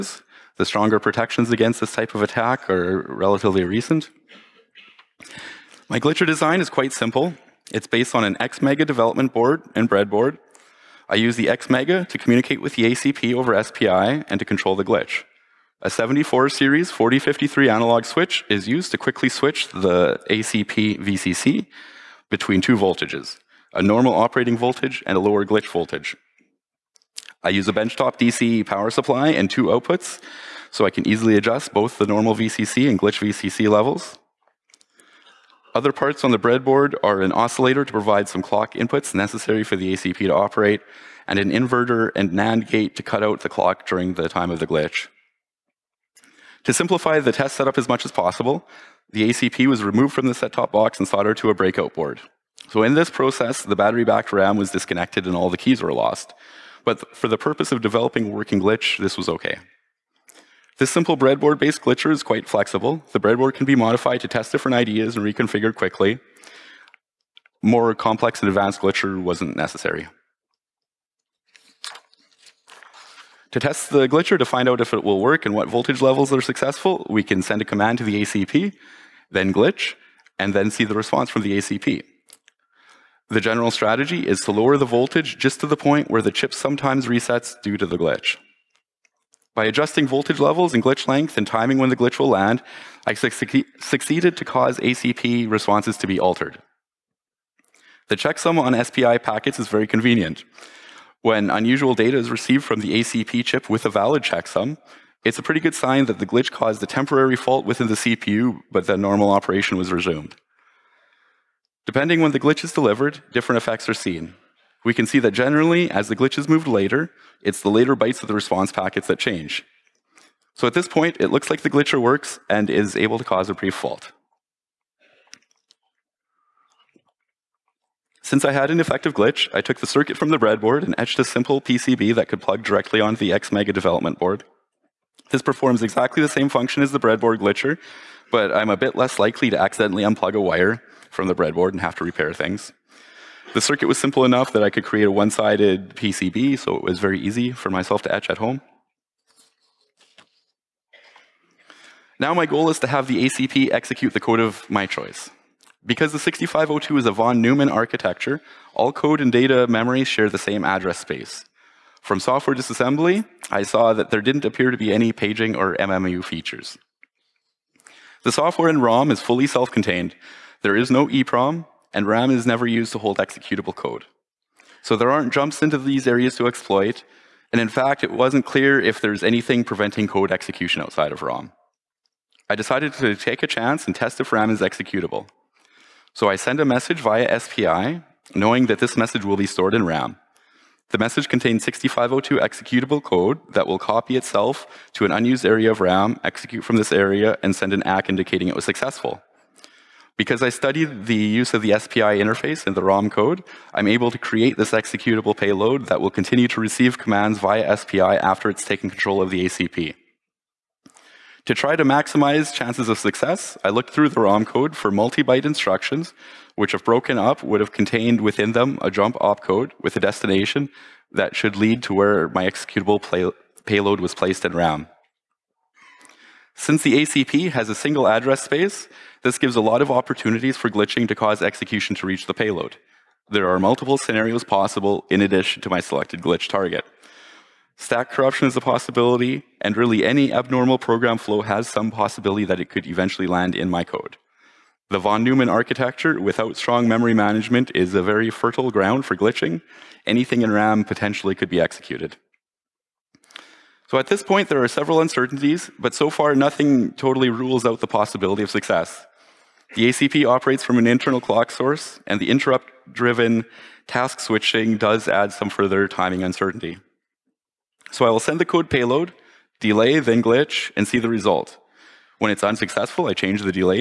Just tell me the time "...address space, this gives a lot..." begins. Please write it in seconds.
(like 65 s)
228 s.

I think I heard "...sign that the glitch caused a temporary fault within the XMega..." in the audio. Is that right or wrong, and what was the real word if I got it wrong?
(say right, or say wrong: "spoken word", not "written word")
wrong: "CPU", not "XMega".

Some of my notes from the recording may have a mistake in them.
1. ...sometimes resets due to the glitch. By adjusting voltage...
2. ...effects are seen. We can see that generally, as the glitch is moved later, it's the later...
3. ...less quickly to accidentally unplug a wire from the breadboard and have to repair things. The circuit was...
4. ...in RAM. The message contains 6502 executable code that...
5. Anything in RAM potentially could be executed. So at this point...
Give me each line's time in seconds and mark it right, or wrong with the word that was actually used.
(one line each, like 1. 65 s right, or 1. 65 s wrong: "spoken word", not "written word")
1. 86 s right
2. 113 s right
3. 138 s wrong: "likely", not "quickly"
4. 189 s right
5. 250 s right.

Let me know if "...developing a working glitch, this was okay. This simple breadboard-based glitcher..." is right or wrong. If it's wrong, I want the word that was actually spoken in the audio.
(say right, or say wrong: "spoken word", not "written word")
right.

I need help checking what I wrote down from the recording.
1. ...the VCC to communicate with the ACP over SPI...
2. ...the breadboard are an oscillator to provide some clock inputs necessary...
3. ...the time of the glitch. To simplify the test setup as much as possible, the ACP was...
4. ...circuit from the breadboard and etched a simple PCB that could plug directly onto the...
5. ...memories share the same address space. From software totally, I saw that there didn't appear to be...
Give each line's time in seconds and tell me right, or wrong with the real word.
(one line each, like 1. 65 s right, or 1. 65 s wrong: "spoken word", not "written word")
1. 11 s wrong: "XMega", not "VCC"
2. 36 s right
3. 44 s right
4. 129 s right
5. 159 s wrong: "disassembly", not "totally".